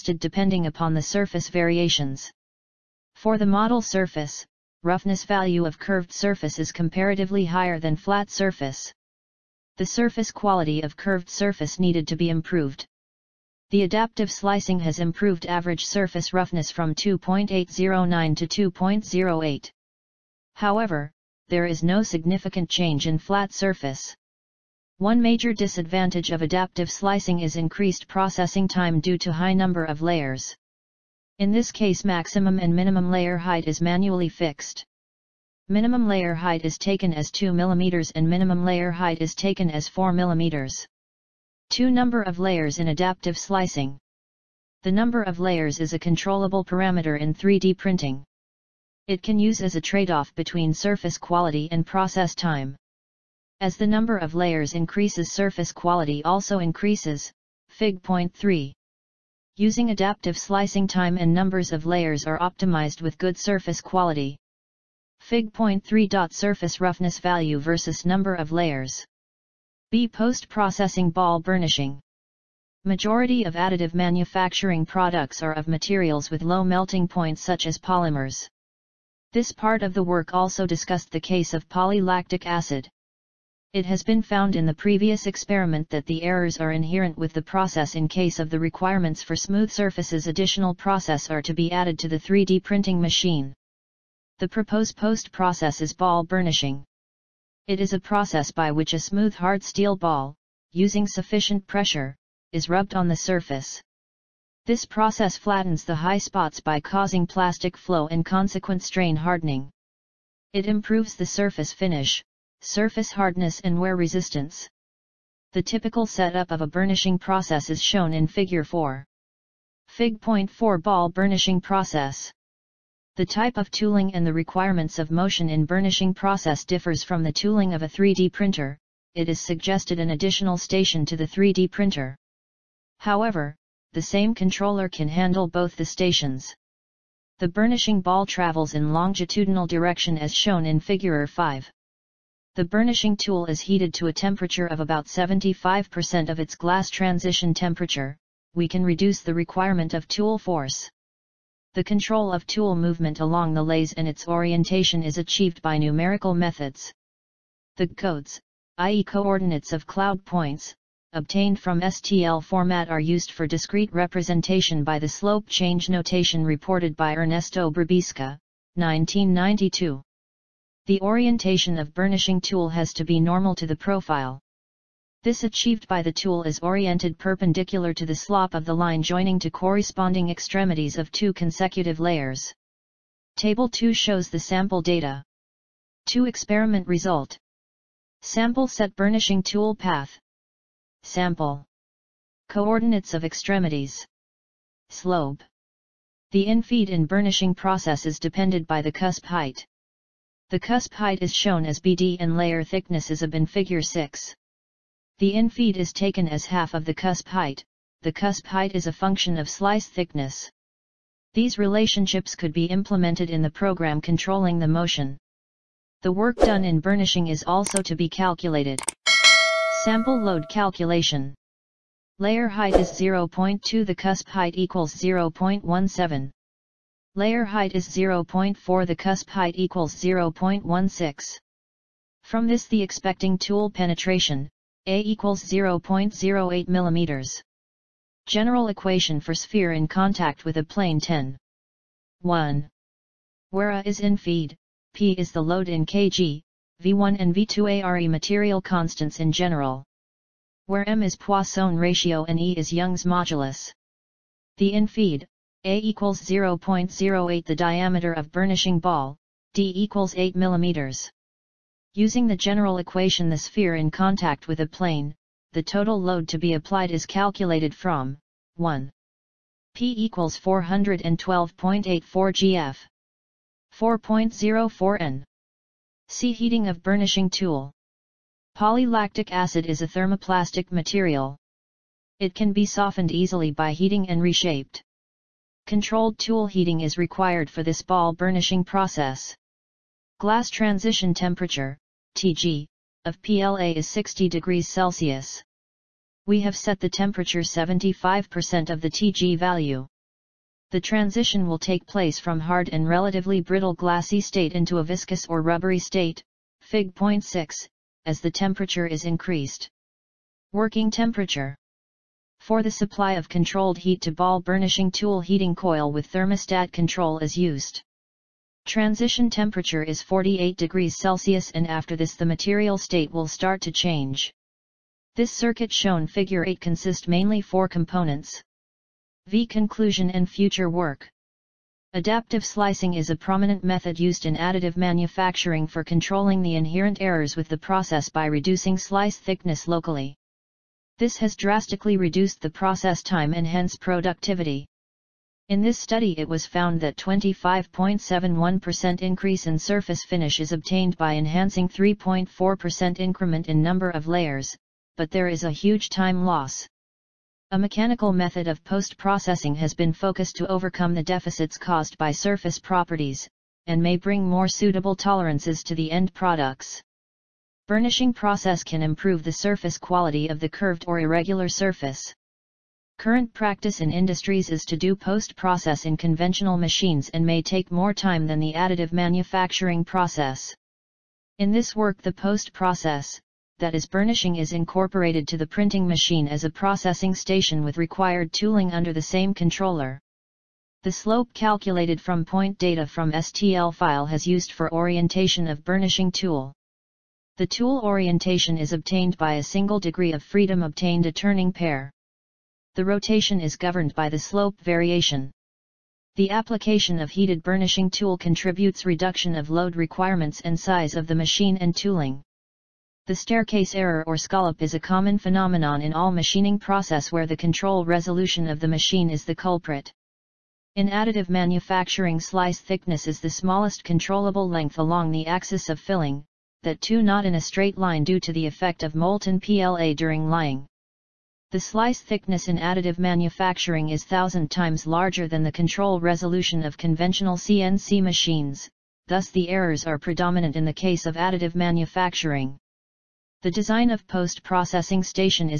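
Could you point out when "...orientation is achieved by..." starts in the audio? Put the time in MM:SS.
02:34.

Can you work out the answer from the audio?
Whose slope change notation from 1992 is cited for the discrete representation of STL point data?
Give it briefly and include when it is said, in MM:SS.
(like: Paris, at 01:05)
Ernesto Brabisca, at 02:47.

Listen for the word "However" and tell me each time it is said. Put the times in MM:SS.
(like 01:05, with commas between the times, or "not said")
00:20, 02:12.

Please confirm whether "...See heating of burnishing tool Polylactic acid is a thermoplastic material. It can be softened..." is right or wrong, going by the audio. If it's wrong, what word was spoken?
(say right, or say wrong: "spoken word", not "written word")
right.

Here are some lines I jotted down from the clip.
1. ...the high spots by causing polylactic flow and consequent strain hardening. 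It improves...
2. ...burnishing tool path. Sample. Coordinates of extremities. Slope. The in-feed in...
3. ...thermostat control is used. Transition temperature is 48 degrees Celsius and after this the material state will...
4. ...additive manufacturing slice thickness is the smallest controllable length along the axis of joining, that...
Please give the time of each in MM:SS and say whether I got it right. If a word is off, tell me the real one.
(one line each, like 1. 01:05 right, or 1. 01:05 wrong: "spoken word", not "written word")
1. 01:45 wrong: "plastic", not "polylactic"
2. 03:08 right
3. 05:16 right
4. 07:00 wrong: "filling", not "joining".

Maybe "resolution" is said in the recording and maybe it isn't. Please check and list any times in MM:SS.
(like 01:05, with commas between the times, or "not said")
06:57, 07:15.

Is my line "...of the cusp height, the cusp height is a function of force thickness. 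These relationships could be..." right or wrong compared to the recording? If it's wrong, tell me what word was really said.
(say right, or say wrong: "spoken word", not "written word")
wrong: "slice", not "force".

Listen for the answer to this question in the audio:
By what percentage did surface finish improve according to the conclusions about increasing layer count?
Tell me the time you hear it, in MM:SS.
05:46.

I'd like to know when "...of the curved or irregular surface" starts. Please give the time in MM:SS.
06:10.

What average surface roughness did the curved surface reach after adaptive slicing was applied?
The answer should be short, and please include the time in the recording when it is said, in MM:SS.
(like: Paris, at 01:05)
2.08, at 00:18.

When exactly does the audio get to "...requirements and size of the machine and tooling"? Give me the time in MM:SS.
06:49.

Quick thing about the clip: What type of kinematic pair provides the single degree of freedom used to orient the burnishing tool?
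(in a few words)
turning pair.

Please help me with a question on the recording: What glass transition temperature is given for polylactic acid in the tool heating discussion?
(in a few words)
60 degrees Celsius.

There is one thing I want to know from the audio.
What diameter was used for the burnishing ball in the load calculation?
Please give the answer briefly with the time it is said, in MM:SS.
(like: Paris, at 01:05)
8 mm, at 04:20.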